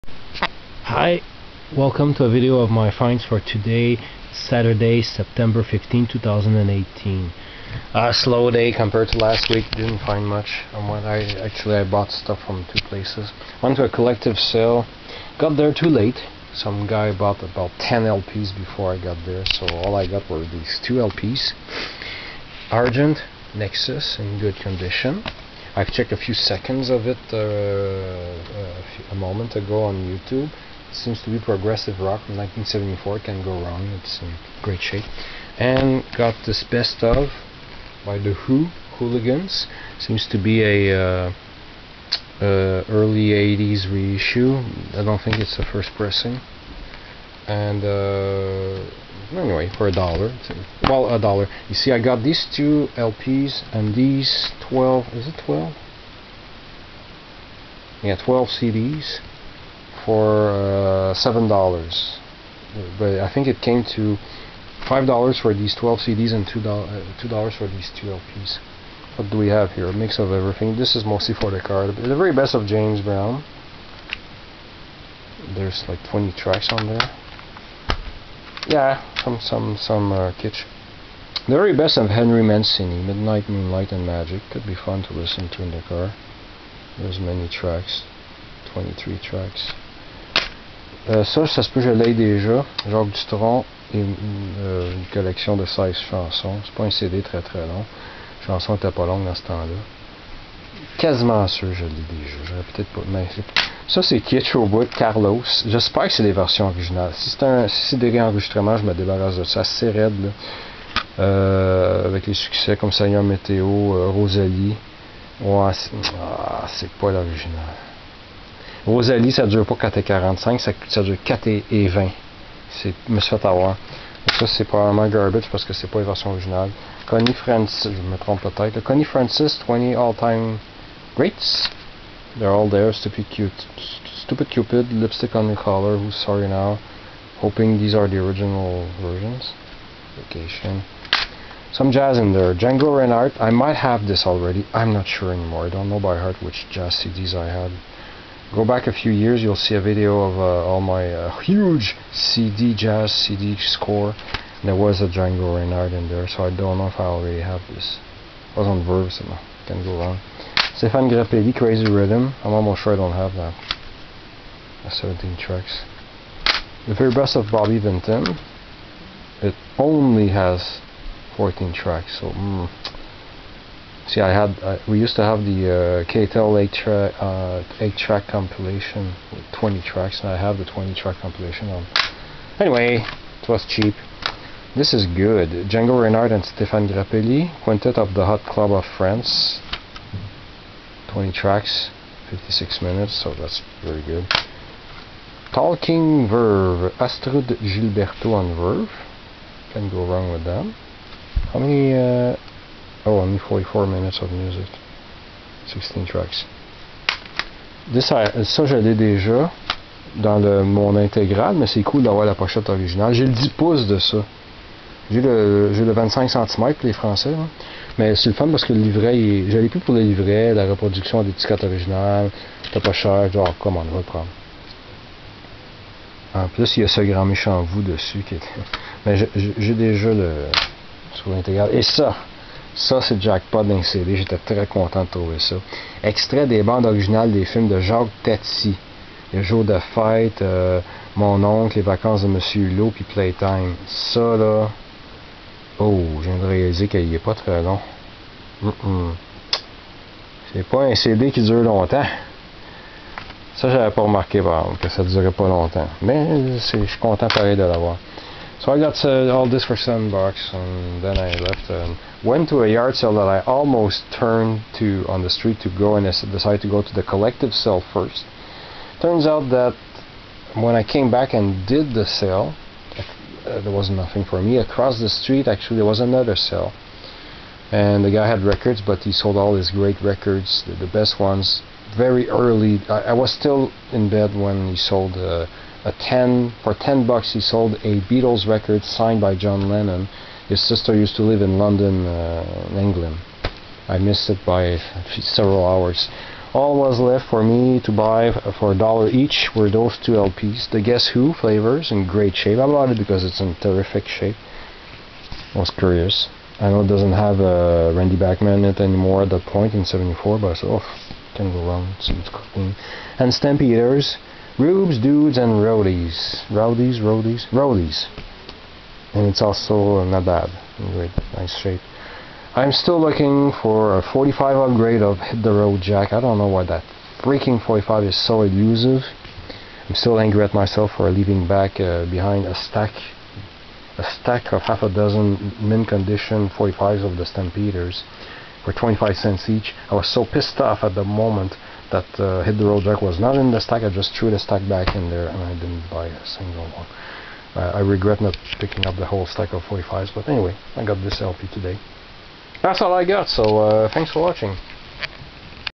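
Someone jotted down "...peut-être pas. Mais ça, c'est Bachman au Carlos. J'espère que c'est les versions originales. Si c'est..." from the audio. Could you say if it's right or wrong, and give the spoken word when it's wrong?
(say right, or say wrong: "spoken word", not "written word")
wrong: "Kitsch", not "Bachman".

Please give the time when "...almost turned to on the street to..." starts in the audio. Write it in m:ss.
4:23.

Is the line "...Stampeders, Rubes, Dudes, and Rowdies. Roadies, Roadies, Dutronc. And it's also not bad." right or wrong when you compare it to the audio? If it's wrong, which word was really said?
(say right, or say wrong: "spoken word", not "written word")
wrong: "Roadies", not "Dutronc".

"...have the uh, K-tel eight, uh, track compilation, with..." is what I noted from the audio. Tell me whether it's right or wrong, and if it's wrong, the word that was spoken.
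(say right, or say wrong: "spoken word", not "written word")
right.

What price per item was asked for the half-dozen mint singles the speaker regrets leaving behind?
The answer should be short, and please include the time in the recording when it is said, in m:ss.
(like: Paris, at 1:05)
25 cents, at 5:38.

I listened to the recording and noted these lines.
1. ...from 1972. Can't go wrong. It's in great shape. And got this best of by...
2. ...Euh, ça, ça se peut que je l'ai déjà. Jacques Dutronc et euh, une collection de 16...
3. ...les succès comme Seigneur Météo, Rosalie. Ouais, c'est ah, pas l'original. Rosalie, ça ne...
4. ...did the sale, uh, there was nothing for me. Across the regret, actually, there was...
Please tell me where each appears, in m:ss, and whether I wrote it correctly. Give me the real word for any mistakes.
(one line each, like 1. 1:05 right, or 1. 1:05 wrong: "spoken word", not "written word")
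1. 0:32 wrong: "1974", not "1972"
2. 1:31 right
3. 1:52 right
4. 4:31 wrong: "street", not "regret".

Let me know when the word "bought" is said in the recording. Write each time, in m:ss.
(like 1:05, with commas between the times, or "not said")
0:11, 0:17, 5:02.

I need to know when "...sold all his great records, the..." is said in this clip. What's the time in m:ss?
4:39.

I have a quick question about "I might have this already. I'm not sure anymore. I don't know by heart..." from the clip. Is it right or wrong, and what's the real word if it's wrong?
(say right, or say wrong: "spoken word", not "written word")
right.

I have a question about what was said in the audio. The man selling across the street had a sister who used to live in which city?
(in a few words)
London.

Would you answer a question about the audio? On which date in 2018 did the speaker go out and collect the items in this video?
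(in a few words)
September 15.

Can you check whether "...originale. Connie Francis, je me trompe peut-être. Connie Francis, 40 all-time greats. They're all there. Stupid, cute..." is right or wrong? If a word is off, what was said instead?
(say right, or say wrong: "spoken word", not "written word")
wrong: "20", not "40".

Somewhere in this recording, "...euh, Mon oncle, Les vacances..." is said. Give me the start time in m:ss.
4:00.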